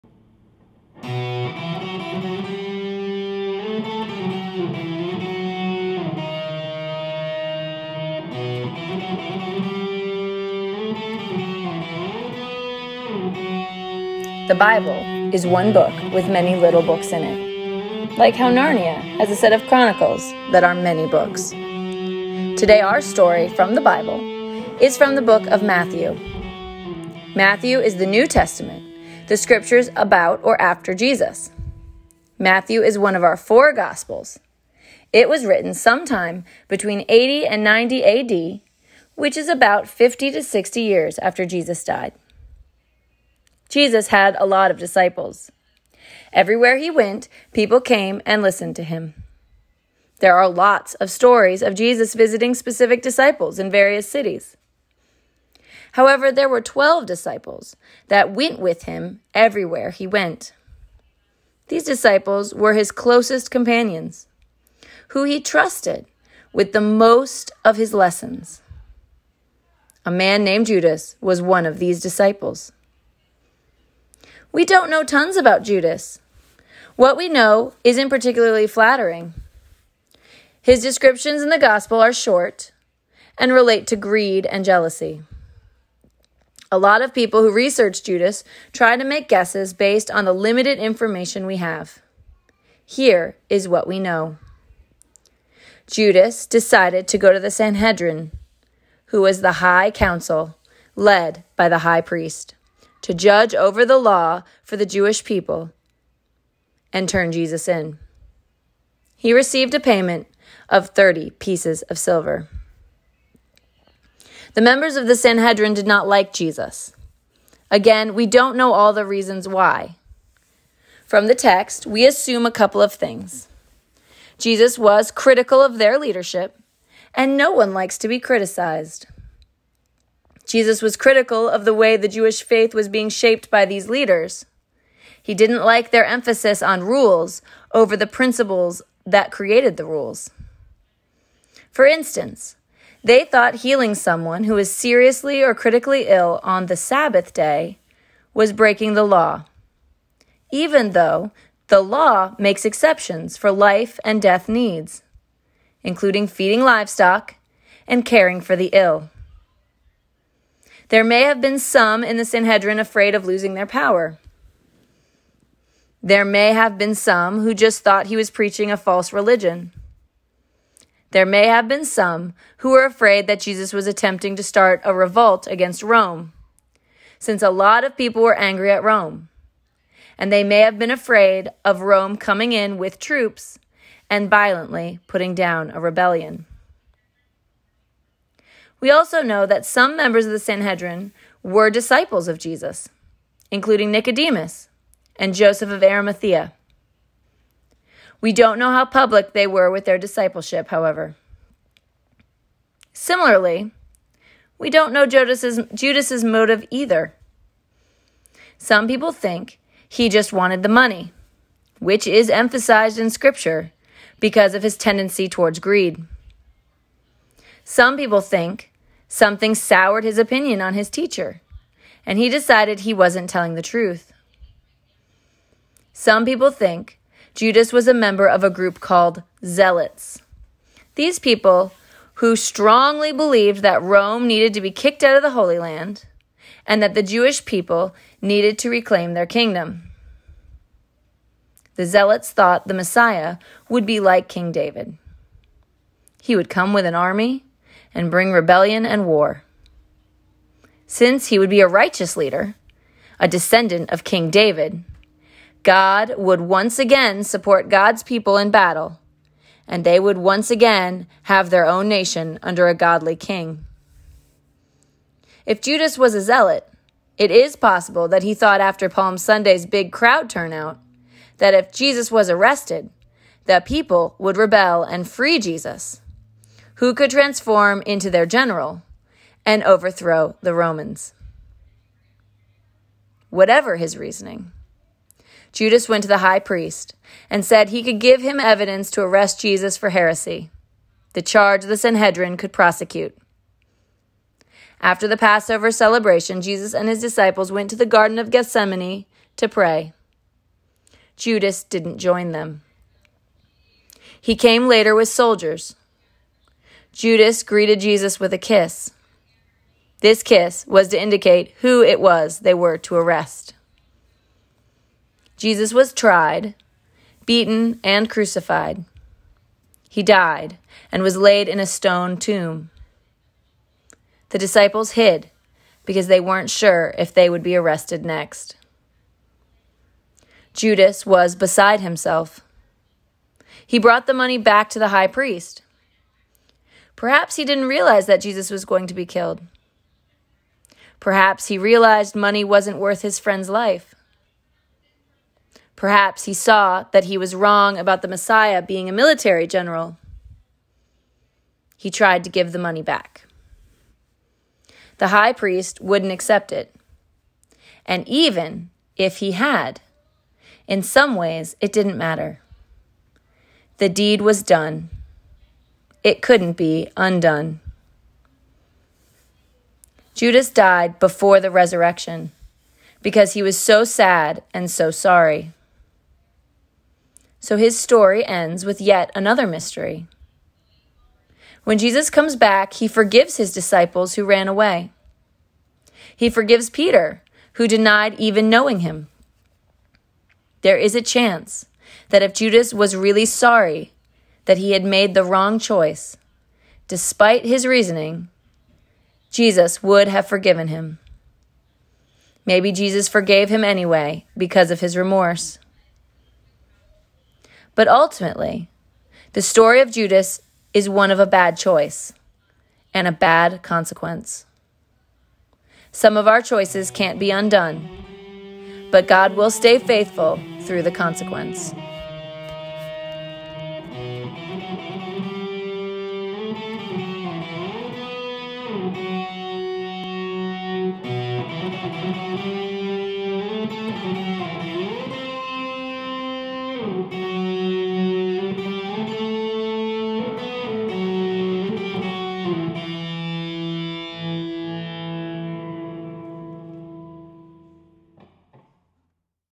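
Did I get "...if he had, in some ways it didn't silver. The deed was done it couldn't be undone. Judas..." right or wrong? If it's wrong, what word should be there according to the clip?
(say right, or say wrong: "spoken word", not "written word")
wrong: "matter", not "silver".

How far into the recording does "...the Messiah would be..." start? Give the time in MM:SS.
04:02.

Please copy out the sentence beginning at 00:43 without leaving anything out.
Jesus had a lot of disciples.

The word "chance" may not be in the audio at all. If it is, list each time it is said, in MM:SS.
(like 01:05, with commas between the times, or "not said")
06:31.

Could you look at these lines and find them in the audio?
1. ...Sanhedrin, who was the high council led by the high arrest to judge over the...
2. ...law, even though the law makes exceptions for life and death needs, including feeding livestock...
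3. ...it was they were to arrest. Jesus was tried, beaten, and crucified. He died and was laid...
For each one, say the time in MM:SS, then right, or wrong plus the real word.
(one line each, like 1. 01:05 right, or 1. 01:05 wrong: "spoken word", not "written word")
1. 01:37 wrong: "priest", not "arrest"
2. 02:29 right
3. 05:11 right.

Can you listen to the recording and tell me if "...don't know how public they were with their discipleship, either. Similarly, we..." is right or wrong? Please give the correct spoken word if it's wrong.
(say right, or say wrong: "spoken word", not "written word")
wrong: "however", not "either".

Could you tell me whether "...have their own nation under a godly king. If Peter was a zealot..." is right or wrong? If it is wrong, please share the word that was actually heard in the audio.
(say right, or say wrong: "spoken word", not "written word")
wrong: "Judas", not "Peter".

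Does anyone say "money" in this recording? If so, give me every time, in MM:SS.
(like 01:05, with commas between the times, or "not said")
03:30, 05:34, 05:42, 05:52.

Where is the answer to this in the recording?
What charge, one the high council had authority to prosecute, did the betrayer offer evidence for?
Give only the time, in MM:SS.
04:49.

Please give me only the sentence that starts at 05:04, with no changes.
He came later with soldiers Judas greeted Jesus with a kiss.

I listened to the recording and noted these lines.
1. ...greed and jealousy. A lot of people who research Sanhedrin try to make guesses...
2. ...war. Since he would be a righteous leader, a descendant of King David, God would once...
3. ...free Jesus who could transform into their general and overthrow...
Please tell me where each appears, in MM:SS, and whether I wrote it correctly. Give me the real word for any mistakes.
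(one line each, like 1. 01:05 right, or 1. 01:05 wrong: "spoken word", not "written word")
1. 01:23 wrong: "Judas", not "Sanhedrin"
2. 04:09 right
3. 04:35 right.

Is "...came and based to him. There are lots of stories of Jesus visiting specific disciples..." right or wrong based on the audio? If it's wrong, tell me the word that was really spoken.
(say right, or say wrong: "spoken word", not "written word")
wrong: "listened", not "based".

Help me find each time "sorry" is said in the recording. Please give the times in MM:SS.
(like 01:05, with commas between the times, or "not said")
06:14, 06:33.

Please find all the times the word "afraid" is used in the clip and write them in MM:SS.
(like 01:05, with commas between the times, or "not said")
02:42, 02:52, 03:00.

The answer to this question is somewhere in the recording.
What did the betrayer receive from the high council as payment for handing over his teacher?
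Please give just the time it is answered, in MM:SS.
01:50.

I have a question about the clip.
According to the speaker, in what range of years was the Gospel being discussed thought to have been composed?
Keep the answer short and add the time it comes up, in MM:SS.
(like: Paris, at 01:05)
80 and 90 AD, at 00:37.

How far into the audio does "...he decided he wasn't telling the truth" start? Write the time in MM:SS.
03:42.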